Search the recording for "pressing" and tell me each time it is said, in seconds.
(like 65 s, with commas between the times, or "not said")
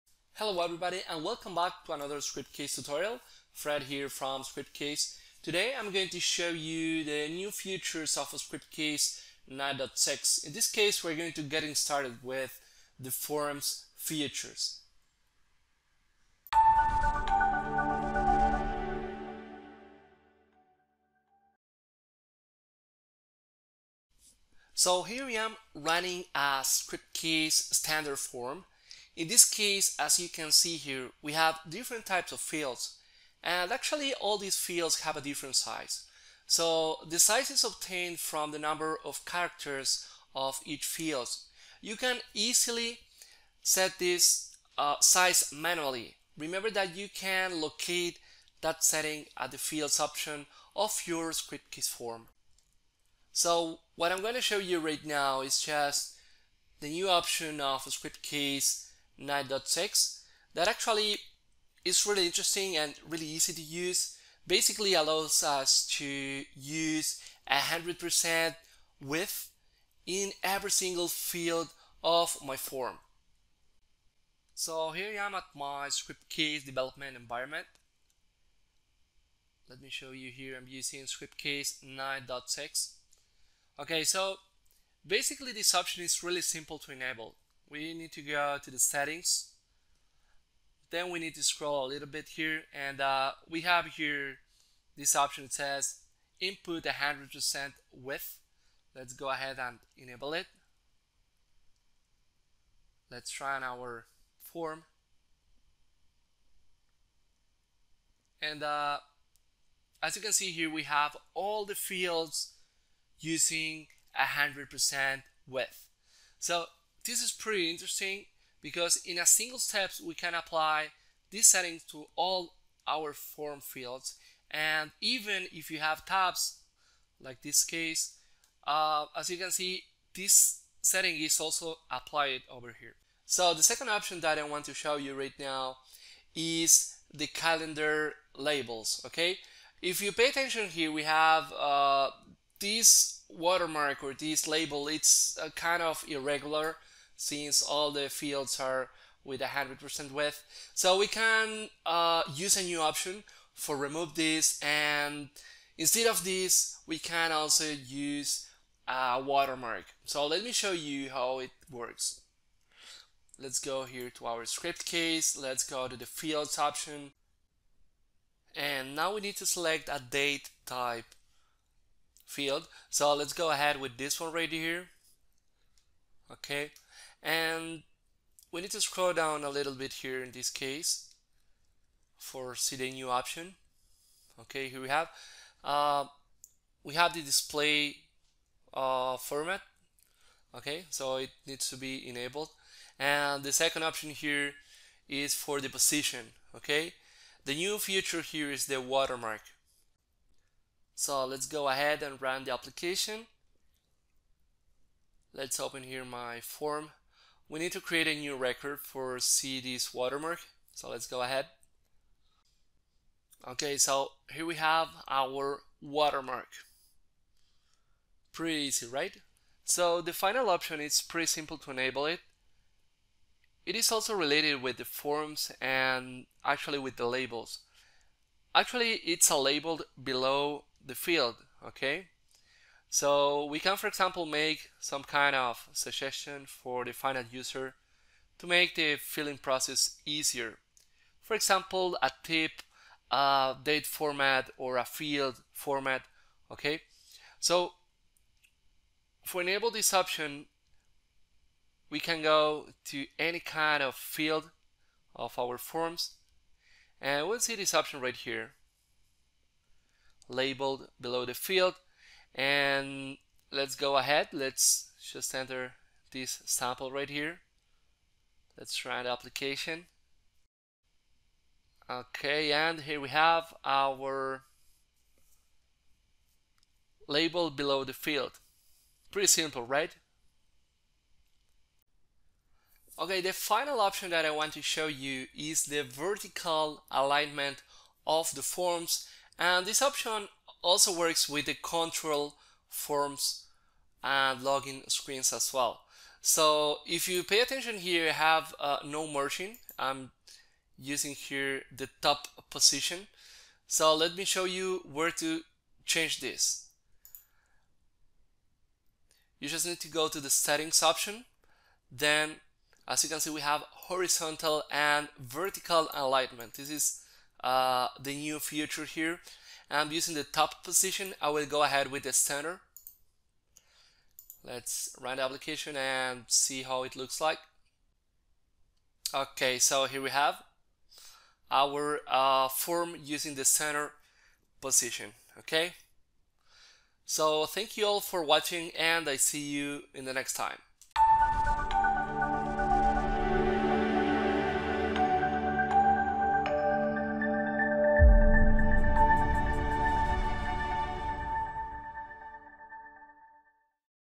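not said.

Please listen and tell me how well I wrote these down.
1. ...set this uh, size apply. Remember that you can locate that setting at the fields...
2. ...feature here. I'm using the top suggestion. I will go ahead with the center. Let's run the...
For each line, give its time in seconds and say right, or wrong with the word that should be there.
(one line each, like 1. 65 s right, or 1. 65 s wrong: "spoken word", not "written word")
1. 43 s wrong: "manually", not "apply"
2. 318 s wrong: "position", not "suggestion".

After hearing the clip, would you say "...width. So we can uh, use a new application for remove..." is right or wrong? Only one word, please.
wrong.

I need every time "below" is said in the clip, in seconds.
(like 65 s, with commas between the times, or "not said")
230 s, 260 s, 277 s.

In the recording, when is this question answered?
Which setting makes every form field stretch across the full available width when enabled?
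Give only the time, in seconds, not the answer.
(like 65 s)
96 s.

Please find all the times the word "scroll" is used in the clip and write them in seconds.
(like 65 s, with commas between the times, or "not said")
91 s, 178 s.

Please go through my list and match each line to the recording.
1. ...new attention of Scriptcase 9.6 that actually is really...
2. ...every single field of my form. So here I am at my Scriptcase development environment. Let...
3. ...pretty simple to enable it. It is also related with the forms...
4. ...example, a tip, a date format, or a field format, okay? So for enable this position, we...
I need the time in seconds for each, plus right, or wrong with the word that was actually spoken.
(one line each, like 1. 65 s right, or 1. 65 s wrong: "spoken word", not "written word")
1. 56 s wrong: "option", not "attention"
2. 70 s right
3. 221 s right
4. 241 s wrong: "option", not "position".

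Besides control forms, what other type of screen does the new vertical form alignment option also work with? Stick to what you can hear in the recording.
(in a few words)
login screens.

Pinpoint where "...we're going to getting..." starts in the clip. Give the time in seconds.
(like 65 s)
11 s.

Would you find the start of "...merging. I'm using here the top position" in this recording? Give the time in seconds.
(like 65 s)
299 s.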